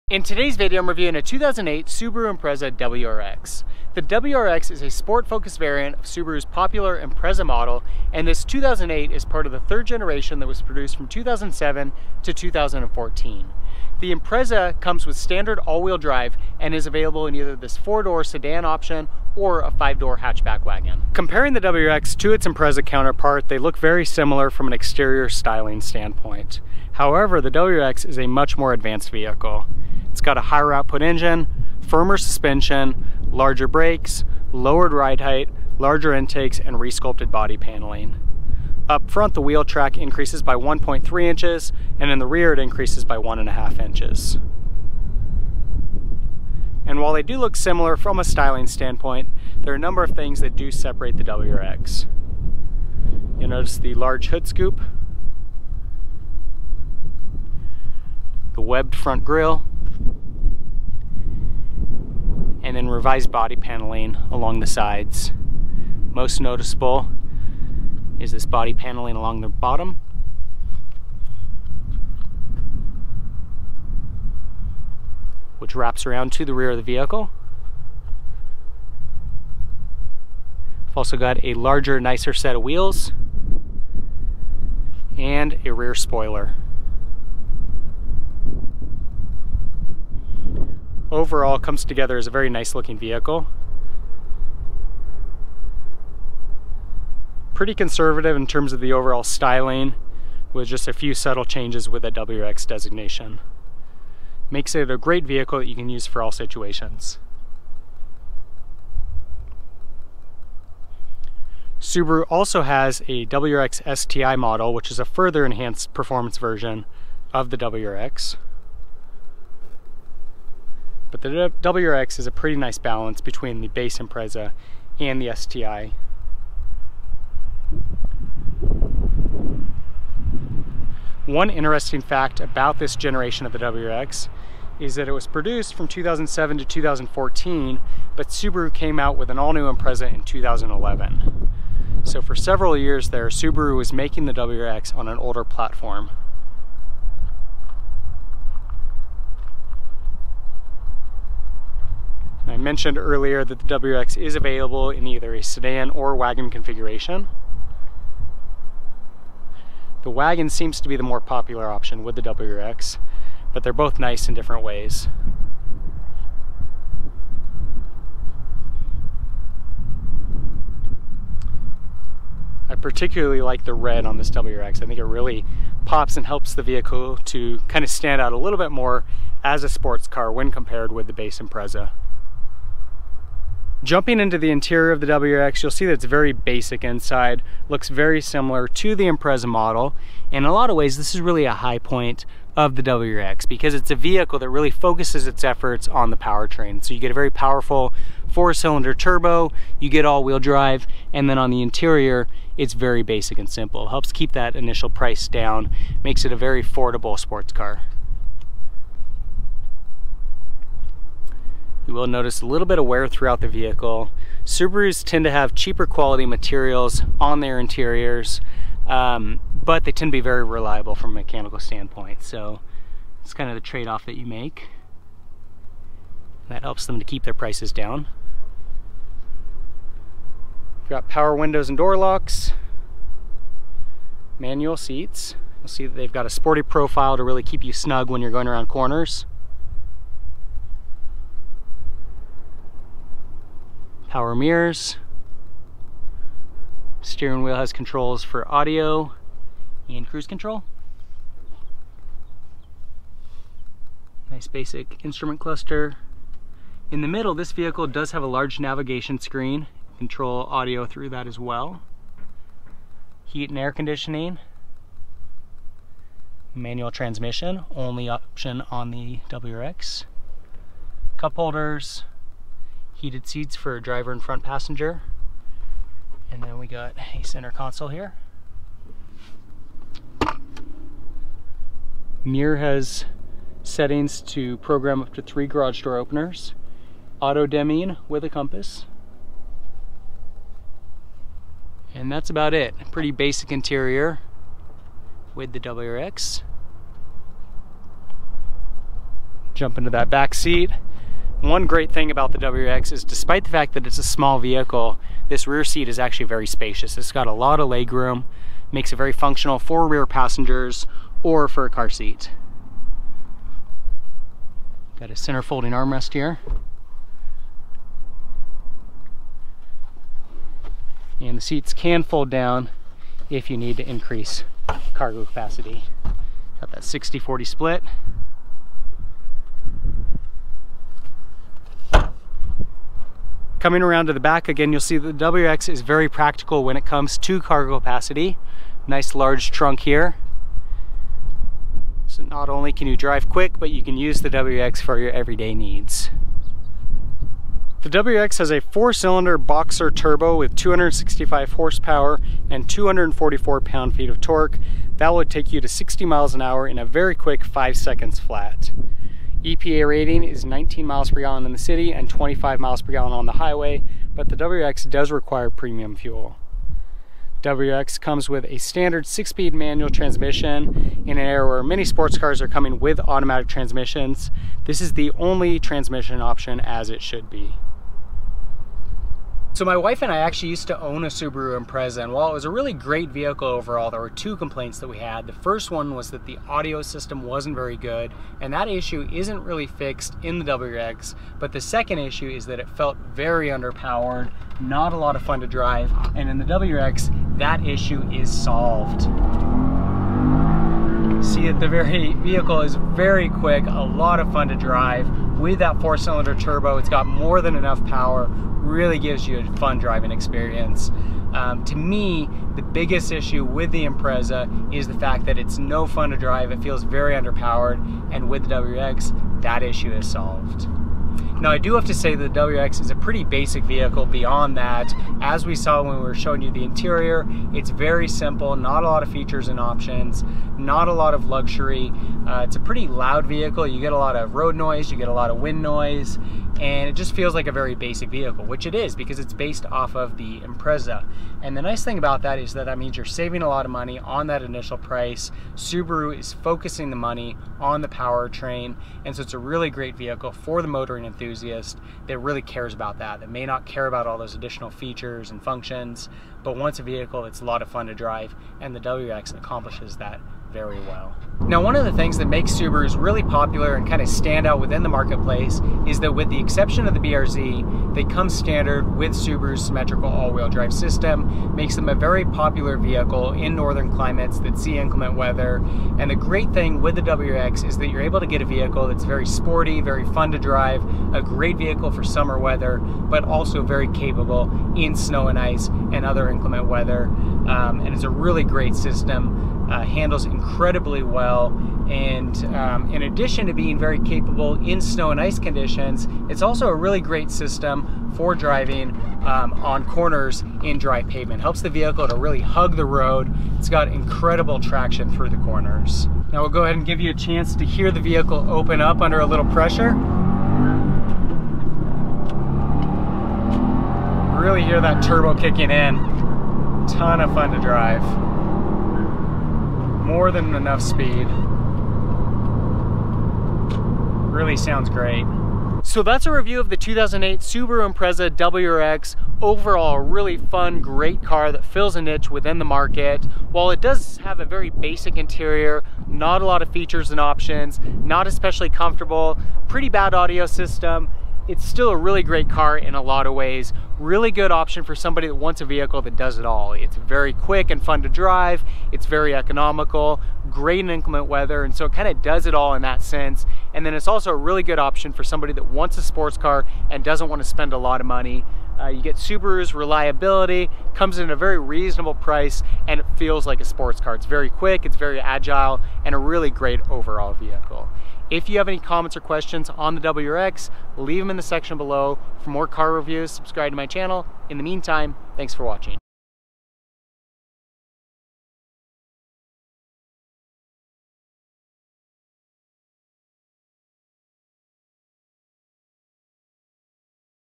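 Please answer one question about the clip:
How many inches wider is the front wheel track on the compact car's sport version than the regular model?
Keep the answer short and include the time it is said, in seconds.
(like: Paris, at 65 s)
1.3 inches, at 40 s.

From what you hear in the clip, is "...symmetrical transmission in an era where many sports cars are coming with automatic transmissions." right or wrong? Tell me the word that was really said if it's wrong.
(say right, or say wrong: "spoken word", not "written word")
wrong: "manual", not "symmetrical".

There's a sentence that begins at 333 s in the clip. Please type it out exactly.
Coming around to the back again, you'll see the WRX is very practical when it comes to cargo capacity.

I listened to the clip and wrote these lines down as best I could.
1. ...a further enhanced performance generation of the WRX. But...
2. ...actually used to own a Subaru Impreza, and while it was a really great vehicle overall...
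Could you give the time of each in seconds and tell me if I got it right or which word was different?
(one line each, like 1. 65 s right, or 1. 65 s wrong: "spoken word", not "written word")
1. 114 s wrong: "version", not "generation"
2. 380 s right.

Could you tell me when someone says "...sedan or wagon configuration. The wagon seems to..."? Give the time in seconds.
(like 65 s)
155 s.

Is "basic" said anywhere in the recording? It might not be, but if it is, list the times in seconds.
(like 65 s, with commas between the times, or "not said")
186 s, 203 s, 254 s, 293 s, 423 s, 437 s, 534 s.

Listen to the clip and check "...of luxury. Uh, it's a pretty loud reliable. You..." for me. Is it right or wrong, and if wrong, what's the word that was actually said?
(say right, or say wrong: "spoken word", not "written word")
wrong: "vehicle", not "reliable".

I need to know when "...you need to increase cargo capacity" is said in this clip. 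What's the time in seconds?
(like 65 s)
323 s.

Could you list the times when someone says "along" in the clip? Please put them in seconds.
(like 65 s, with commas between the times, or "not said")
64 s, 69 s.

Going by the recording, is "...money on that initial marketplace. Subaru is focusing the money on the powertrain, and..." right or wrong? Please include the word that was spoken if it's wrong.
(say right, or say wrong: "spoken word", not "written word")
wrong: "price", not "marketplace".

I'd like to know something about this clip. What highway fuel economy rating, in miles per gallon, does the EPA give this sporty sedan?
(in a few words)
25.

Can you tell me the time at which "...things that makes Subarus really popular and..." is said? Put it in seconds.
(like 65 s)
461 s.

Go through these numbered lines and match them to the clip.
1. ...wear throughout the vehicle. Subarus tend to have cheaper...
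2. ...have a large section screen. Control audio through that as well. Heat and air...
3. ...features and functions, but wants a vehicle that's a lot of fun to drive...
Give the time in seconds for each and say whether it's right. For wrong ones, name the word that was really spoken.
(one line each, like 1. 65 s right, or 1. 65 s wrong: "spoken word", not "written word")
1. 212 s right
2. 258 s wrong: "navigation", not "section"
3. 454 s right.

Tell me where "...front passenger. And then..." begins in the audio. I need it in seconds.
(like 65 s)
274 s.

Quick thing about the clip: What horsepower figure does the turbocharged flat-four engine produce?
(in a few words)
265.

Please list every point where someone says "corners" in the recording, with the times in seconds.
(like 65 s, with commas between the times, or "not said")
238 s, 499 s, 505 s.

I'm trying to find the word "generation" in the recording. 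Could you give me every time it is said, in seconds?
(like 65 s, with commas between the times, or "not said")
9 s, 132 s.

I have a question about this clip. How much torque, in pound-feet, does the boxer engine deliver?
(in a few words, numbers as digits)
244.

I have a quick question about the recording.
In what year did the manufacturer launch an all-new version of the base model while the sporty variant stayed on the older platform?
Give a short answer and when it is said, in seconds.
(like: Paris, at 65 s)
2011, at 140 s.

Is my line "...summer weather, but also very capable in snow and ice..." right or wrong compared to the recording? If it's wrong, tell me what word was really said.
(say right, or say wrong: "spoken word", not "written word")
right.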